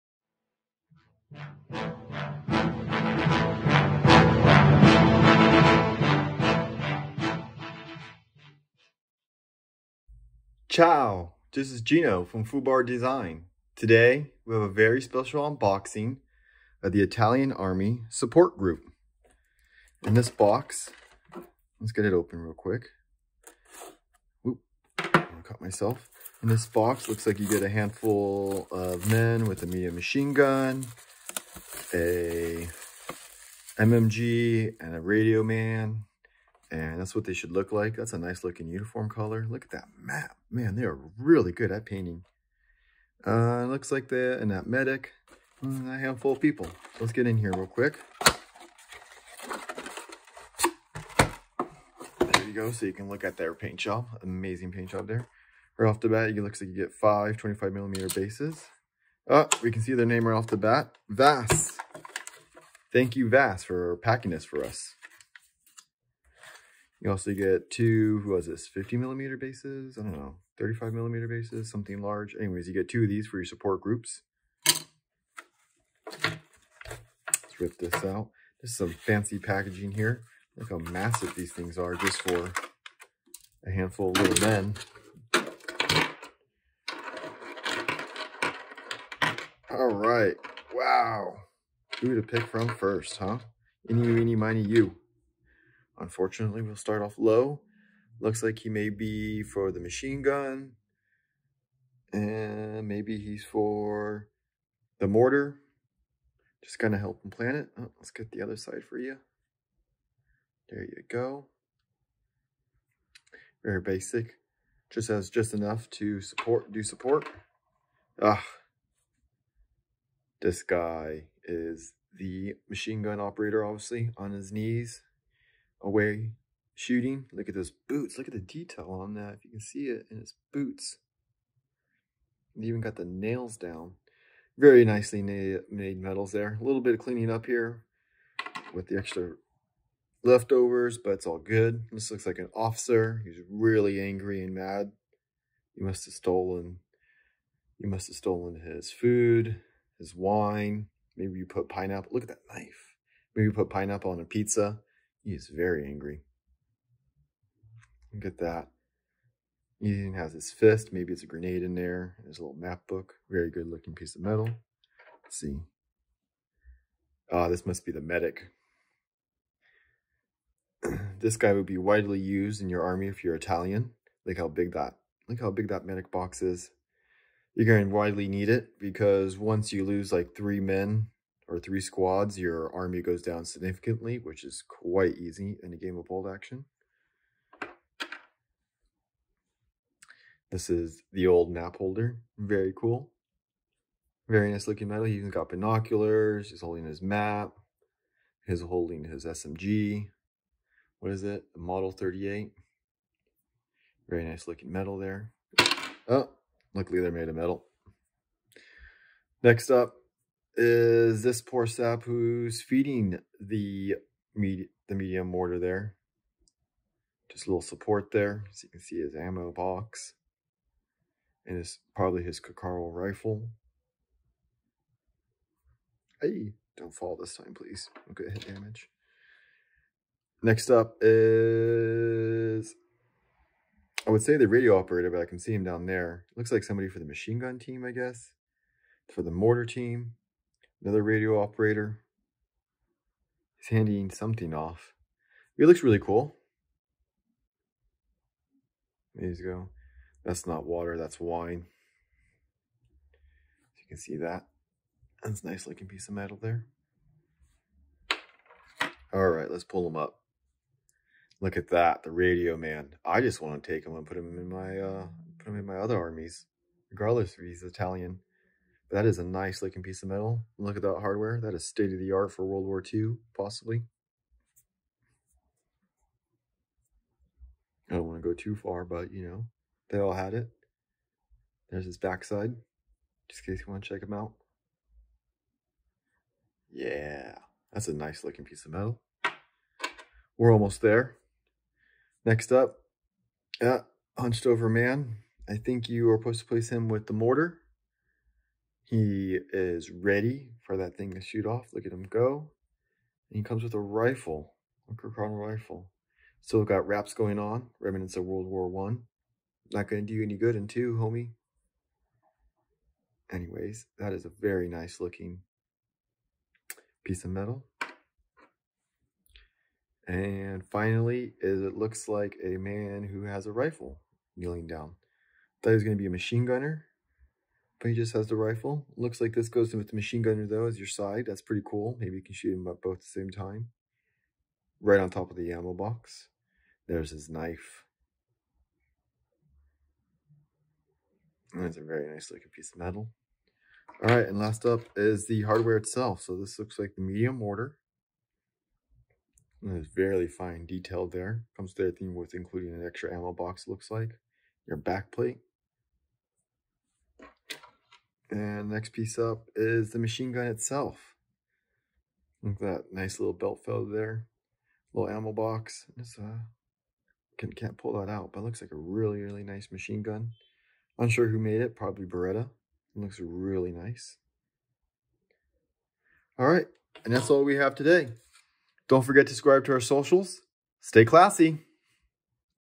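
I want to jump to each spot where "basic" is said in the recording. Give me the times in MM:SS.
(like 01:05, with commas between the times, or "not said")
01:53.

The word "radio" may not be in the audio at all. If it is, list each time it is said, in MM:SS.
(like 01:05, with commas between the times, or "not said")
00:35, 03:54, 04:01, 04:22.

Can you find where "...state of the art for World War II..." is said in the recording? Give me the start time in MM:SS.
04:31.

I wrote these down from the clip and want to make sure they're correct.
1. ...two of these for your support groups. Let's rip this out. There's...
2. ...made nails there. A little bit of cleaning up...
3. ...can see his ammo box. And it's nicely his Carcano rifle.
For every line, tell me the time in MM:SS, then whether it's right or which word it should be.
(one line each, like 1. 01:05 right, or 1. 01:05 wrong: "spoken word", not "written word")
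1. 01:12 right
2. 02:15 wrong: "metals", not "nails"
3. 03:38 wrong: "probably", not "nicely".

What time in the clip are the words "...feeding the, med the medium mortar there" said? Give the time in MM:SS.
03:32.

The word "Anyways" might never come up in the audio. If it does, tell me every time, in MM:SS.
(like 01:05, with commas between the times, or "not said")
01:12, 05:13.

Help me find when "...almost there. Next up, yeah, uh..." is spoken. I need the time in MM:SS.
04:50.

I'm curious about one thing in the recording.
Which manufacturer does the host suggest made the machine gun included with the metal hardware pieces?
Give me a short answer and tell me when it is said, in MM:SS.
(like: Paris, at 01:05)
Beretta, at 06:12.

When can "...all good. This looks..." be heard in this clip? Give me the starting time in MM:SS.
02:21.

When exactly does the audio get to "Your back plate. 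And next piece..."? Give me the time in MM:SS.
05:54.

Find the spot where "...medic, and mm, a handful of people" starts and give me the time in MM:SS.
00:44.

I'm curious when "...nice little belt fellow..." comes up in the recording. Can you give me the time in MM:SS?
06:02.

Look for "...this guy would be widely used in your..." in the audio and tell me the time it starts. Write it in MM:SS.
02:51.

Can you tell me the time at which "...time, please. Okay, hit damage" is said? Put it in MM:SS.
03:47.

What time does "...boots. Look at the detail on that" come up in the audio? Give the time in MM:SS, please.
02:07.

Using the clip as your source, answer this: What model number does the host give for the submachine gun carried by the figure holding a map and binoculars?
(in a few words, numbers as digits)
38.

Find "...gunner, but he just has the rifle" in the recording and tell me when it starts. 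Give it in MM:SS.
05:26.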